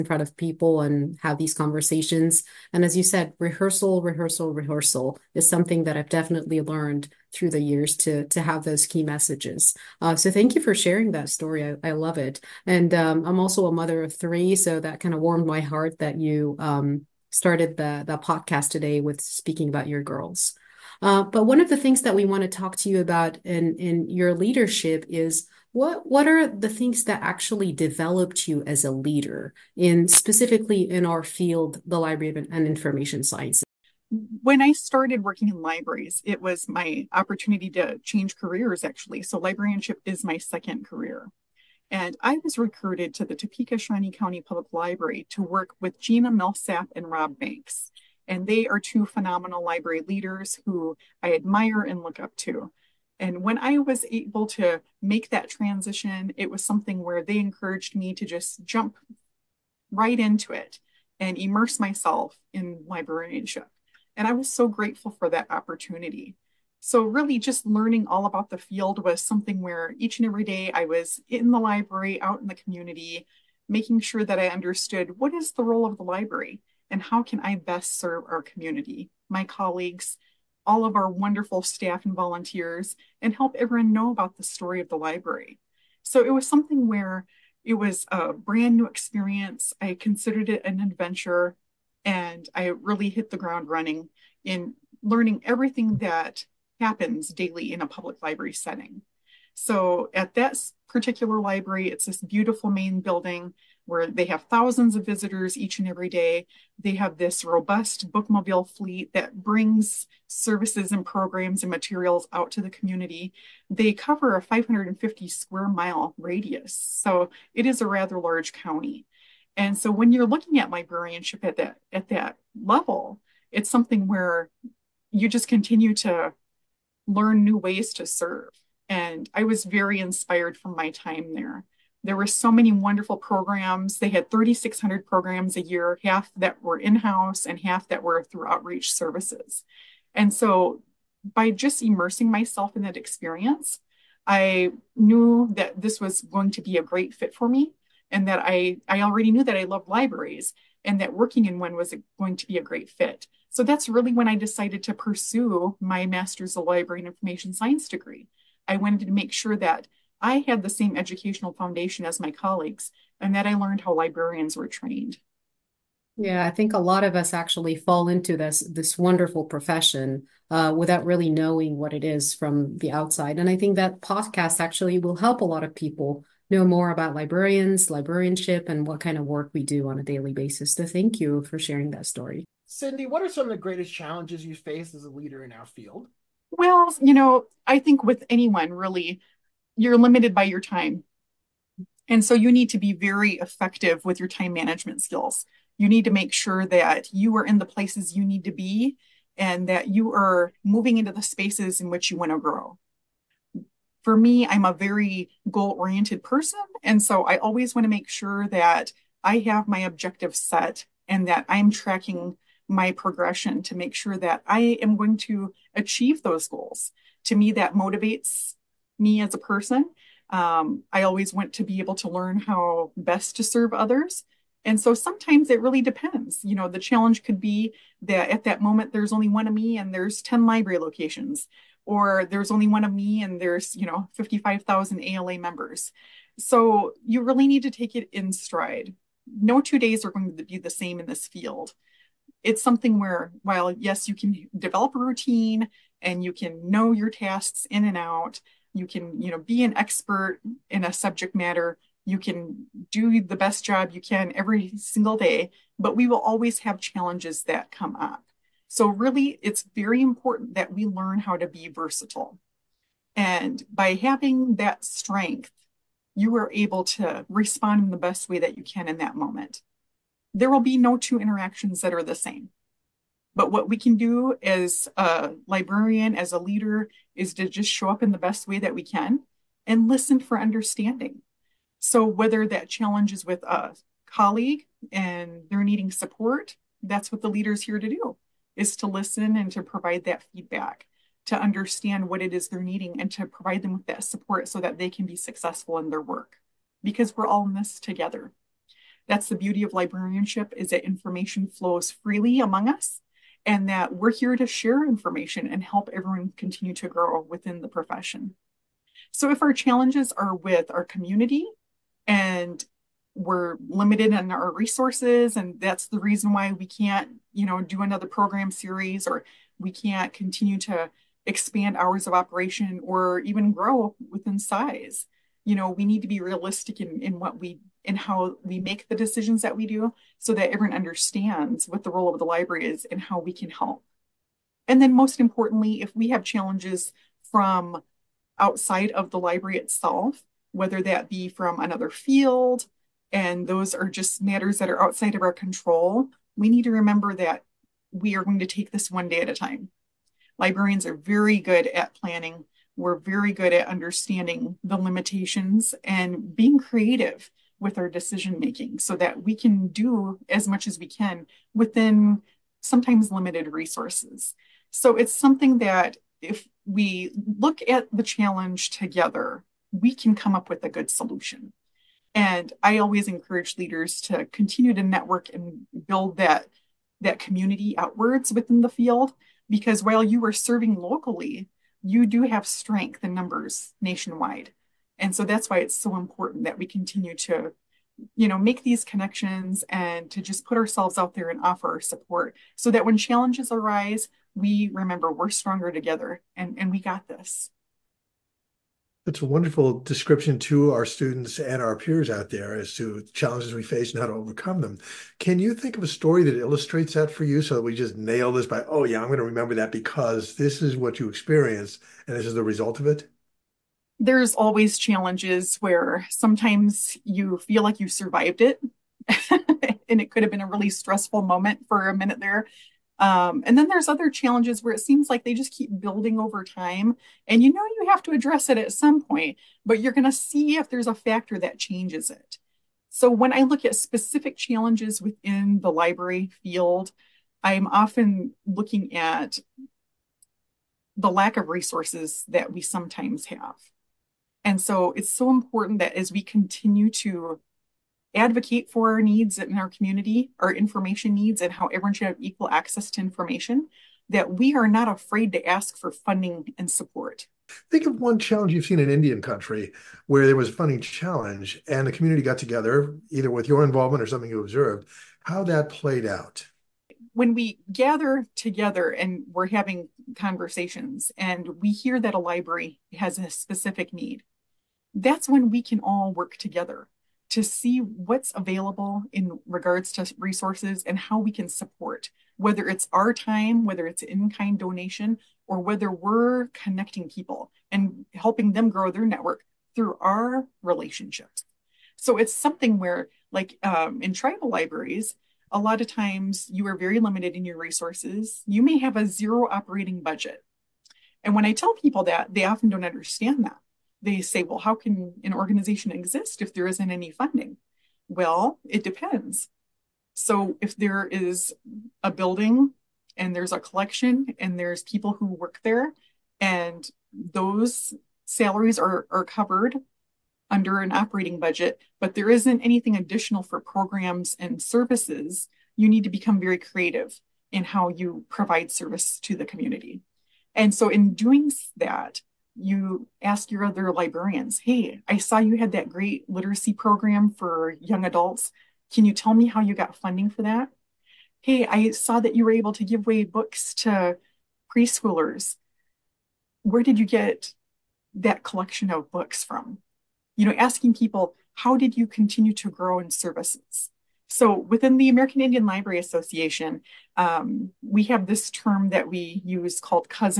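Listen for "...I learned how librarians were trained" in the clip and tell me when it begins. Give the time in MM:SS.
02:43.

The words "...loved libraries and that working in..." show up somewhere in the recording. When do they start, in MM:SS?
02:29.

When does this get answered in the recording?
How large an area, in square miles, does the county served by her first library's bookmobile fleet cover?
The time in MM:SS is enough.
01:54.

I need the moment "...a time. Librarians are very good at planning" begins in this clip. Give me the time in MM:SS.
05:49.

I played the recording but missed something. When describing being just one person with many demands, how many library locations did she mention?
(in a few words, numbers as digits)
10.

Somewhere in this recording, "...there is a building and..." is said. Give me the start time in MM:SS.
08:30.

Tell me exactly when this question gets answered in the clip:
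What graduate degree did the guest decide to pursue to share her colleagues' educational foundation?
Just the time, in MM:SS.
02:36.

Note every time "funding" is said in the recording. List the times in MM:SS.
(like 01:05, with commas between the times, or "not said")
07:35, 07:40, 08:27, 08:59.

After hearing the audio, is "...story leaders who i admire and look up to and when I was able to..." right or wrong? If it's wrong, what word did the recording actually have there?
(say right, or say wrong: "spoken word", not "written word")
wrong: "library", not "story".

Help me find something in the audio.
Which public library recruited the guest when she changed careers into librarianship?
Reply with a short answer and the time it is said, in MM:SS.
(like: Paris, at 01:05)
Topeka Shawnee County Public Library, at 00:43.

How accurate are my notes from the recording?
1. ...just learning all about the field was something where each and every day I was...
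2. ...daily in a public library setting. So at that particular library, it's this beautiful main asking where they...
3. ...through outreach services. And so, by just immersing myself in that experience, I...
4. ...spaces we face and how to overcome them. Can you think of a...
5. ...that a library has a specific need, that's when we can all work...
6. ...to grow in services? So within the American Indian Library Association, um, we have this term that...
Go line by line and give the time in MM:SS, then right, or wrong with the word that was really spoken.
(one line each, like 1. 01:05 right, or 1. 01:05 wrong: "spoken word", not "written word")
1. 01:07 right
2. 01:37 wrong: "building", not "asking"
3. 02:18 right
4. 06:43 wrong: "challenges", not "spaces"
5. 07:51 right
6. 09:12 right.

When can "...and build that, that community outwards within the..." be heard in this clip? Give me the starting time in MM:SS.
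06:15.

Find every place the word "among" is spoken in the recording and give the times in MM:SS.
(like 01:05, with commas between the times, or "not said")
05:02.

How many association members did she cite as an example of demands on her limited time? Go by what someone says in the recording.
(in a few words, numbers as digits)
55,000.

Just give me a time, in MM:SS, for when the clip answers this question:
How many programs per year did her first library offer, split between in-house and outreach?
02:14.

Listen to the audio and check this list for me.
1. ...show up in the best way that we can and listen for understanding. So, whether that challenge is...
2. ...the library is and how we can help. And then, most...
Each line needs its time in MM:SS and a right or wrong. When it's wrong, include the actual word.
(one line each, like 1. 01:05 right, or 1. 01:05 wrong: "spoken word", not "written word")
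1. 04:37 right
2. 05:32 right.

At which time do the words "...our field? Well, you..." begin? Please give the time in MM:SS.
03:05.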